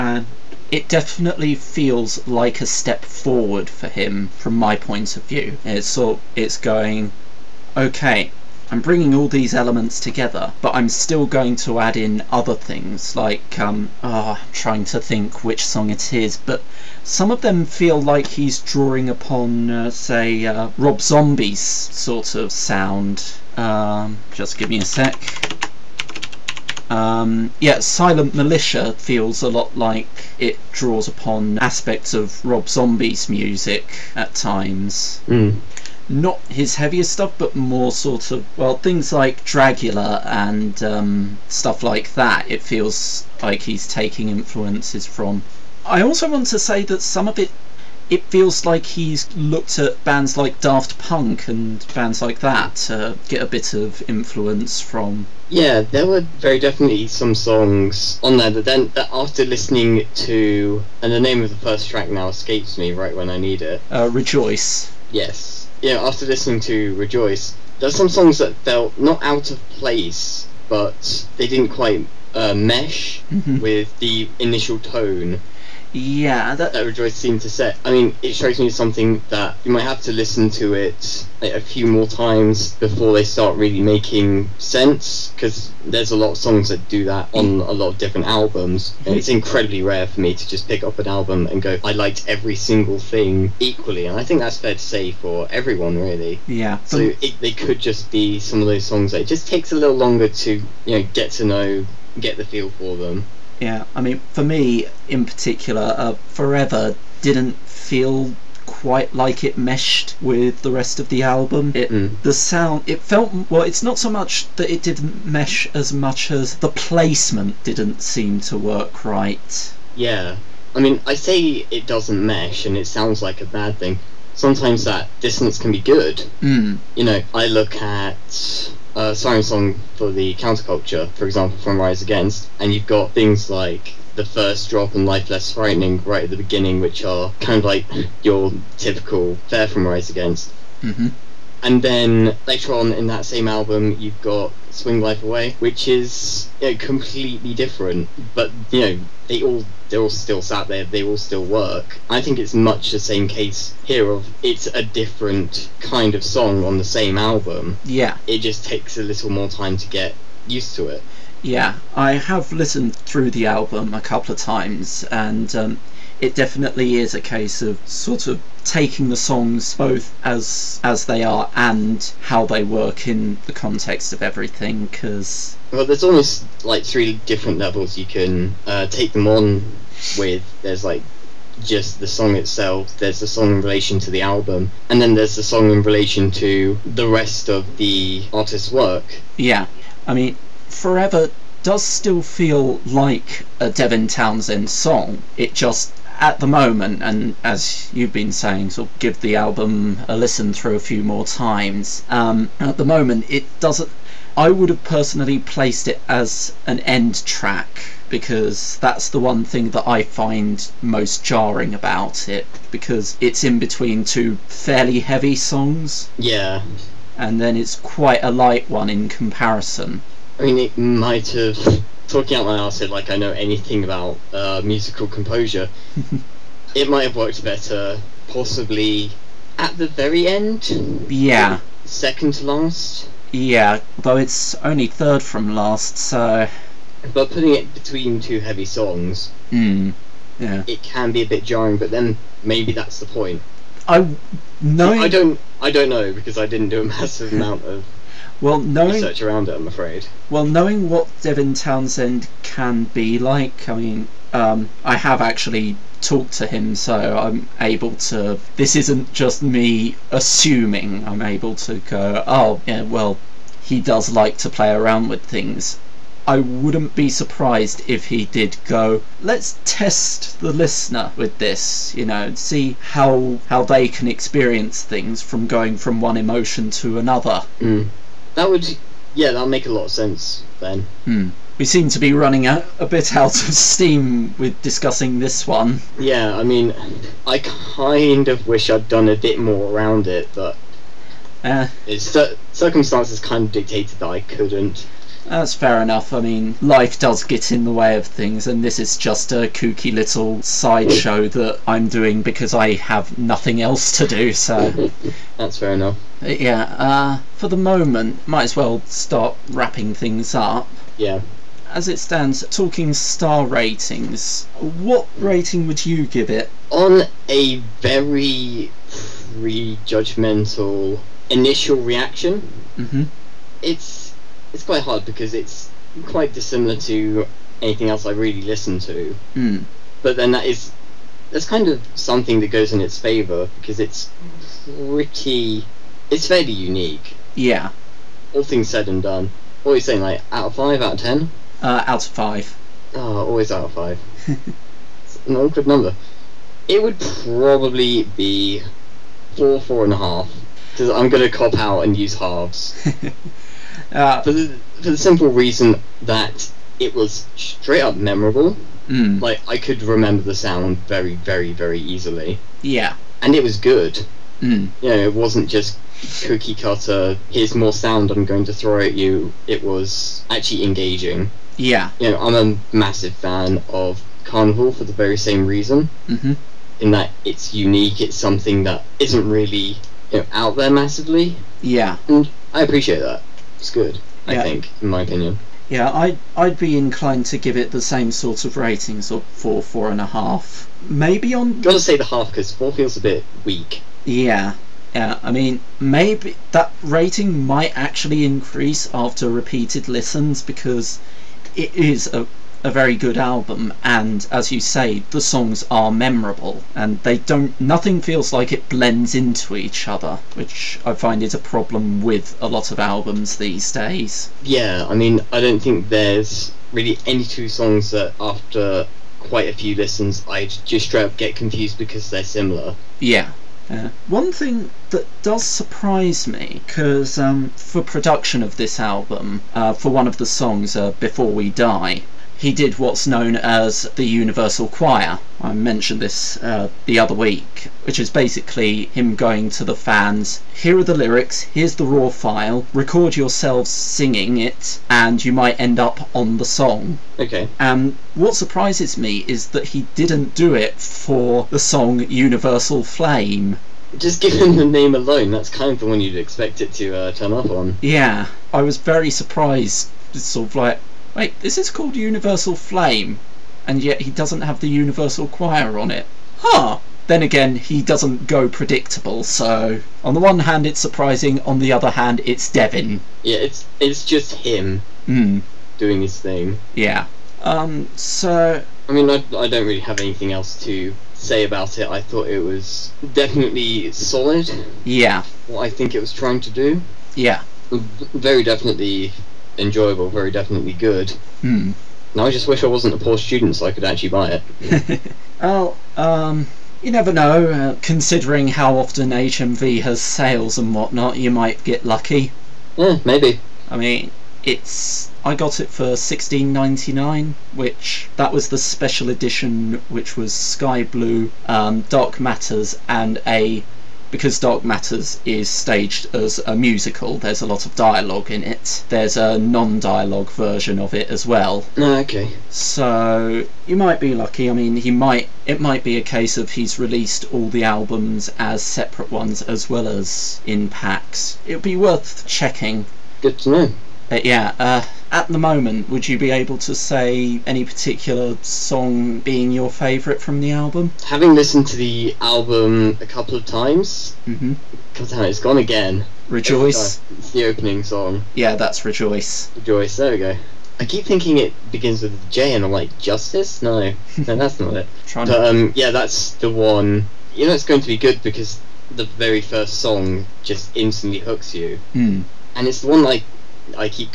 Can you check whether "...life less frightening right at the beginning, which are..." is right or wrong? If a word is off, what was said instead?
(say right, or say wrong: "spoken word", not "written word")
right.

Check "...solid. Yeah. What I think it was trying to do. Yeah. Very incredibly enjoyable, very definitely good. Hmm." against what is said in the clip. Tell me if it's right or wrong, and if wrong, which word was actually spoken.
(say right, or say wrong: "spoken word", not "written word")
wrong: "definitely", not "incredibly".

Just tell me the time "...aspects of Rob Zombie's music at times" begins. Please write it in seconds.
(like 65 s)
31 s.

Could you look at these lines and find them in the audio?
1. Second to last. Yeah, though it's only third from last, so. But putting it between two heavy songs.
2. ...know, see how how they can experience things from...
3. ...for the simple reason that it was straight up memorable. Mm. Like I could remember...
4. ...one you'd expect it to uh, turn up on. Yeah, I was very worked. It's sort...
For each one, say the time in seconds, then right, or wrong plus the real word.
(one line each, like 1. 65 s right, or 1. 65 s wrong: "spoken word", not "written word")
1. 231 s right
2. 272 s right
3. 354 s right
4. 455 s wrong: "surprised", not "worked".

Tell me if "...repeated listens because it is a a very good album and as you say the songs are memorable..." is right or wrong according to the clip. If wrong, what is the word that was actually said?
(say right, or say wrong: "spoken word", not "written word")
right.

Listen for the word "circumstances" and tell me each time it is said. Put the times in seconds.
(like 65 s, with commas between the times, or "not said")
292 s.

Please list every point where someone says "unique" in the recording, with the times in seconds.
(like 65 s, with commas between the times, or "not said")
336 s, 377 s.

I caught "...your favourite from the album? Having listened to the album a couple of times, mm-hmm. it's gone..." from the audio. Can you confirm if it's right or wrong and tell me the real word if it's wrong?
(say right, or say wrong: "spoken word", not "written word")
right.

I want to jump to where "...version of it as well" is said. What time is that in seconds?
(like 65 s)
520 s.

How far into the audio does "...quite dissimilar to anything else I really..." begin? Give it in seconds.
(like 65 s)
326 s.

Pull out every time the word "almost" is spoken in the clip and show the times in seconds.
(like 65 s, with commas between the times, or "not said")
176 s.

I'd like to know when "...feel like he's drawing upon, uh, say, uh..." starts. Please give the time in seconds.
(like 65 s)
17 s.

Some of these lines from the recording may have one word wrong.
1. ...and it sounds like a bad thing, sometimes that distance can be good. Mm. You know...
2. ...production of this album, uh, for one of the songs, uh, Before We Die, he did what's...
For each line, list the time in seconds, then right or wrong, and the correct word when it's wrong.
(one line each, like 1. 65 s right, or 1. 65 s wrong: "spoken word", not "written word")
1. 122 s right
2. 427 s right.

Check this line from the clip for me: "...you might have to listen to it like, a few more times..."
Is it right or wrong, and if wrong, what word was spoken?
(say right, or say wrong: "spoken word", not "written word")
right.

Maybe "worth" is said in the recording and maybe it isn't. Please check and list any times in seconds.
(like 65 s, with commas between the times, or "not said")
531 s.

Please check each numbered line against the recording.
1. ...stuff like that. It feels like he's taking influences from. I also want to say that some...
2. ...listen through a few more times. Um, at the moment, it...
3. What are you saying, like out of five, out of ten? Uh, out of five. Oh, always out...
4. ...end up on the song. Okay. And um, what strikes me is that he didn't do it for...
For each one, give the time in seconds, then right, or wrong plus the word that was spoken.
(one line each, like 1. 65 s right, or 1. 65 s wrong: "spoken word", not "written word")
1. 41 s right
2. 200 s right
3. 339 s right
4. 445 s wrong: "surprises", not "strikes".